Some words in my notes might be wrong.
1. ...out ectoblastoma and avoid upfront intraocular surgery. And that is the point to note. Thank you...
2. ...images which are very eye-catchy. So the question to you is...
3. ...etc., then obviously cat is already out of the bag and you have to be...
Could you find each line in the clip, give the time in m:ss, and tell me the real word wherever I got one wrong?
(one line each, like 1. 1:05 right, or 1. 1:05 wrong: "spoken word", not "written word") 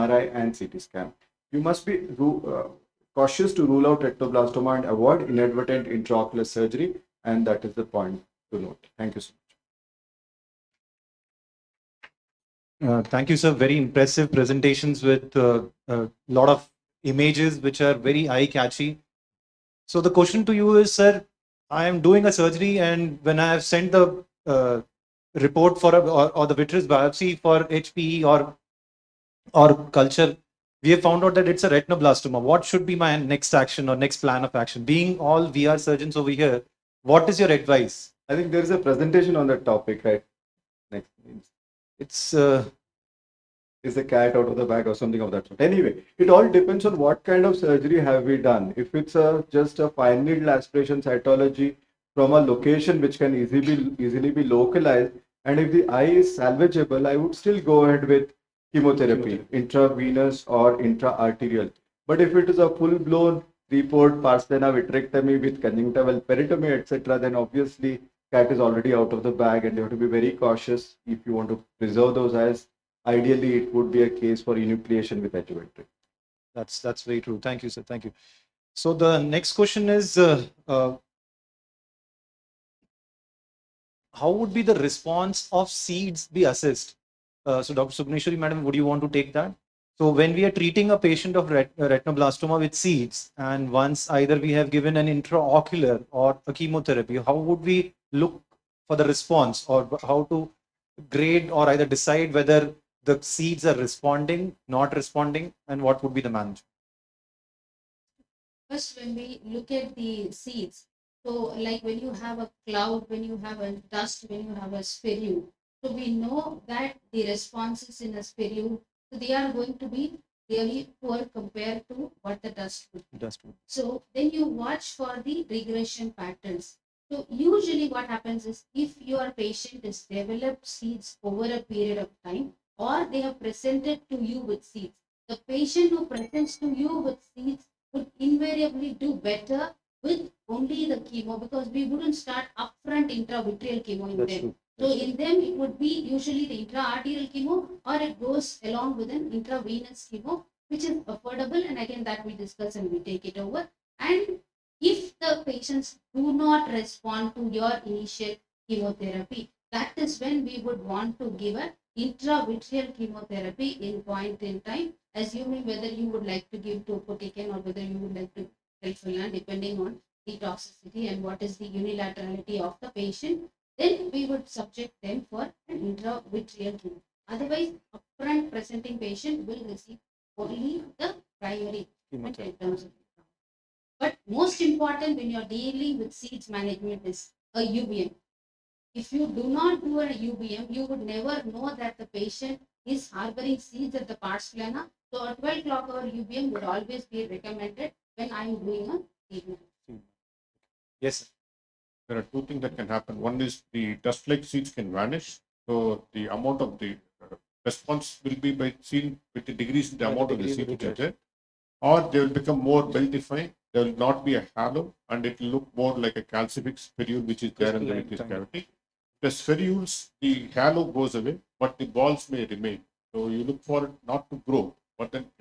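1. 0:03 wrong: "inadvertent", not "upfront"
2. 0:17 right
3. 1:06 right.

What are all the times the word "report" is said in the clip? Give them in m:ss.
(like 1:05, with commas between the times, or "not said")
0:25, 1:03.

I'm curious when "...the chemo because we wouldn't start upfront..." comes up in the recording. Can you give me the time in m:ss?
2:20.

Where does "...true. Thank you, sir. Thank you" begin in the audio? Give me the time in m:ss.
1:17.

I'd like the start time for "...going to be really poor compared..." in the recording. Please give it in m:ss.
1:59.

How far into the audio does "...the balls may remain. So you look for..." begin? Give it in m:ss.
3:41.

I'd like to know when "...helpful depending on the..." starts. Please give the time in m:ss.
2:48.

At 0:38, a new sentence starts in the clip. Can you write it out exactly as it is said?
I think there is a presentation on that topic, right?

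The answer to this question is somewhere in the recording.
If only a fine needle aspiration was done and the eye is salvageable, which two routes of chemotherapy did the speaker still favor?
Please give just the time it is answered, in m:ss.
0:59.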